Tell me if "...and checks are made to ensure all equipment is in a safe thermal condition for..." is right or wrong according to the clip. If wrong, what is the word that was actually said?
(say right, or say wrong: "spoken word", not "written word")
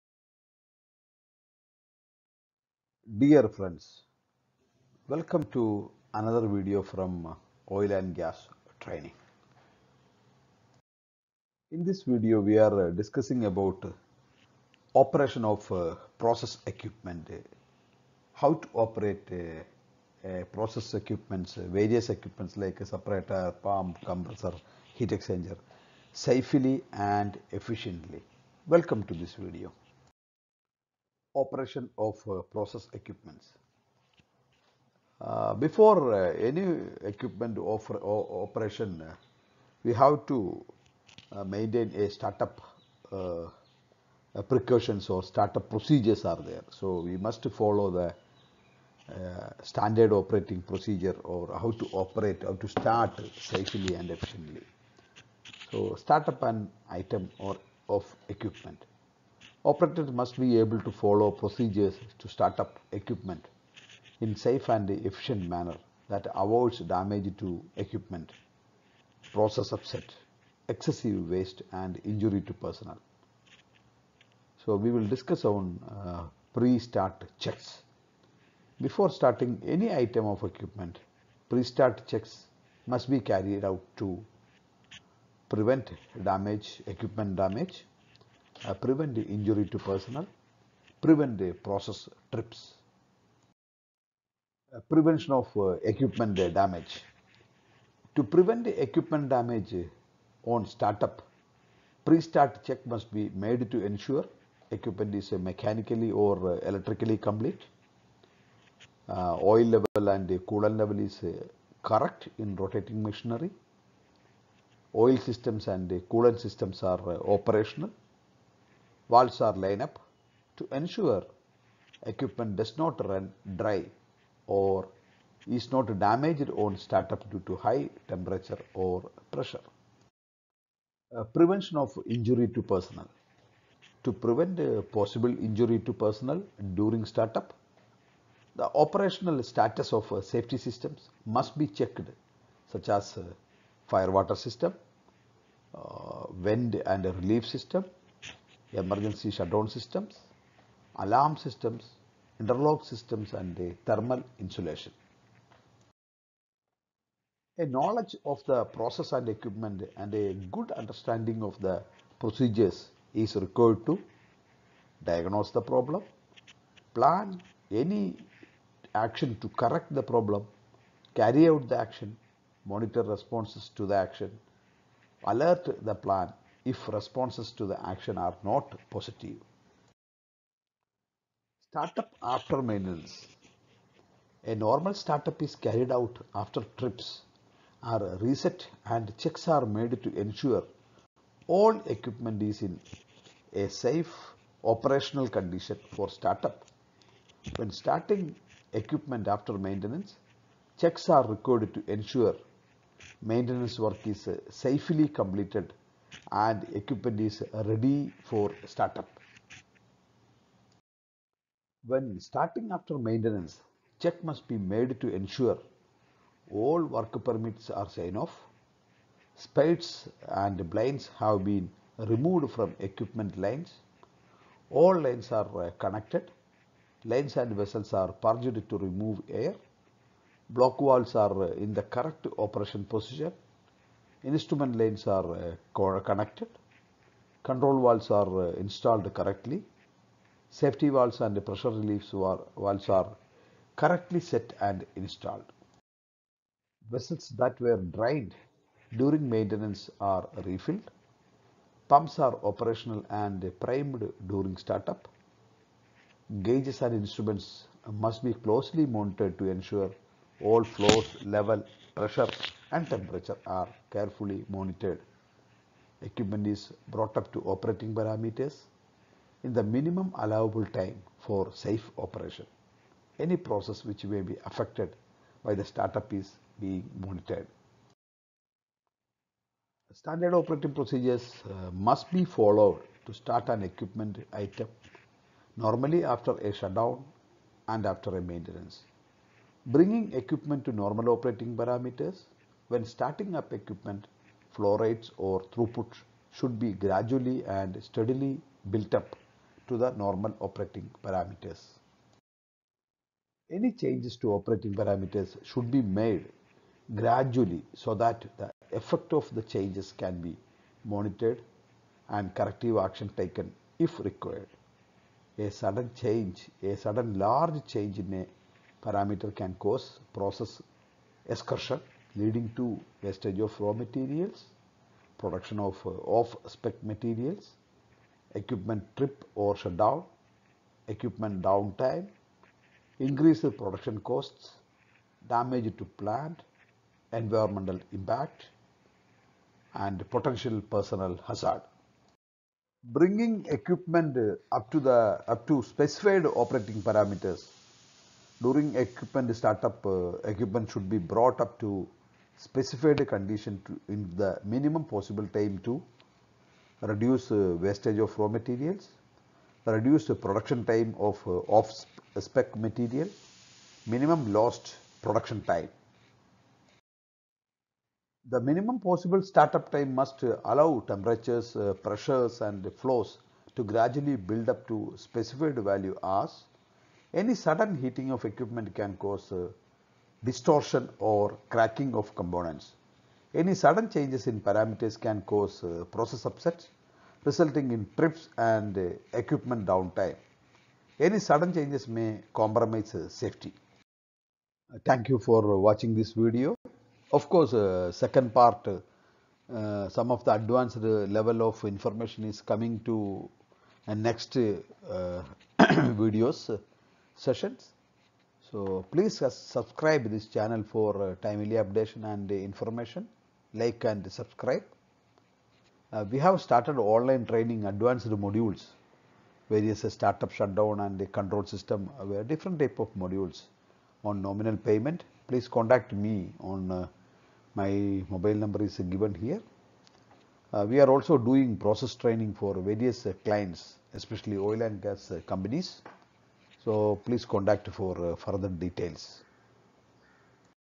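wrong: "operational", not "thermal".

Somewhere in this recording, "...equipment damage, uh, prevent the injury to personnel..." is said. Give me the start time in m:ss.
1:26.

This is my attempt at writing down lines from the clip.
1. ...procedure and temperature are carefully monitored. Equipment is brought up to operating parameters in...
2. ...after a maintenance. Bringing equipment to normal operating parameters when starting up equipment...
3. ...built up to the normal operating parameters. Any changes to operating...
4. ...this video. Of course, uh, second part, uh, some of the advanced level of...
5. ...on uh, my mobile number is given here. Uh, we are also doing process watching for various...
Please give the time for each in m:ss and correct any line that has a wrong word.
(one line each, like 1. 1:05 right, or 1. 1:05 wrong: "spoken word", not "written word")
1. 4:21 wrong: "pressure", not "procedure"
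2. 4:47 right
3. 4:58 right
4. 6:35 right
5. 7:06 wrong: "training", not "watching".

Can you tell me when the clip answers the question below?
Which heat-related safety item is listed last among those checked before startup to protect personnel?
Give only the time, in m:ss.
2:33.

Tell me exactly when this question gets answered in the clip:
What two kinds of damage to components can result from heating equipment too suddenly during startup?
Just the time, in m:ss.
6:20.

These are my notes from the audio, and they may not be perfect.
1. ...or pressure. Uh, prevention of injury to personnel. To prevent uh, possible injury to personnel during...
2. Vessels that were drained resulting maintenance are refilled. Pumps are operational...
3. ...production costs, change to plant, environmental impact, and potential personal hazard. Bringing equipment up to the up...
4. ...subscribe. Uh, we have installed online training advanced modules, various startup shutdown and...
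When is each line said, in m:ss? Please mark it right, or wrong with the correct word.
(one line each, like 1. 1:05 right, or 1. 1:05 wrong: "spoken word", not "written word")
1. 2:08 right
2. 4:06 wrong: "during", not "resulting"
3. 5:33 wrong: "damage", not "change"
4. 6:54 wrong: "started", not "installed".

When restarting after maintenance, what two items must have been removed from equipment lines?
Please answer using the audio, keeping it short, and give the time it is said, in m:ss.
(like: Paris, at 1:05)
Spades and blinds, at 3:39.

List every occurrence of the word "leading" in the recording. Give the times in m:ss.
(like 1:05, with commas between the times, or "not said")
5:22.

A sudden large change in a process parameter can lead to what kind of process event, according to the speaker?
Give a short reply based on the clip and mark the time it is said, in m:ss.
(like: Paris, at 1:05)
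Process excursion, at 5:20.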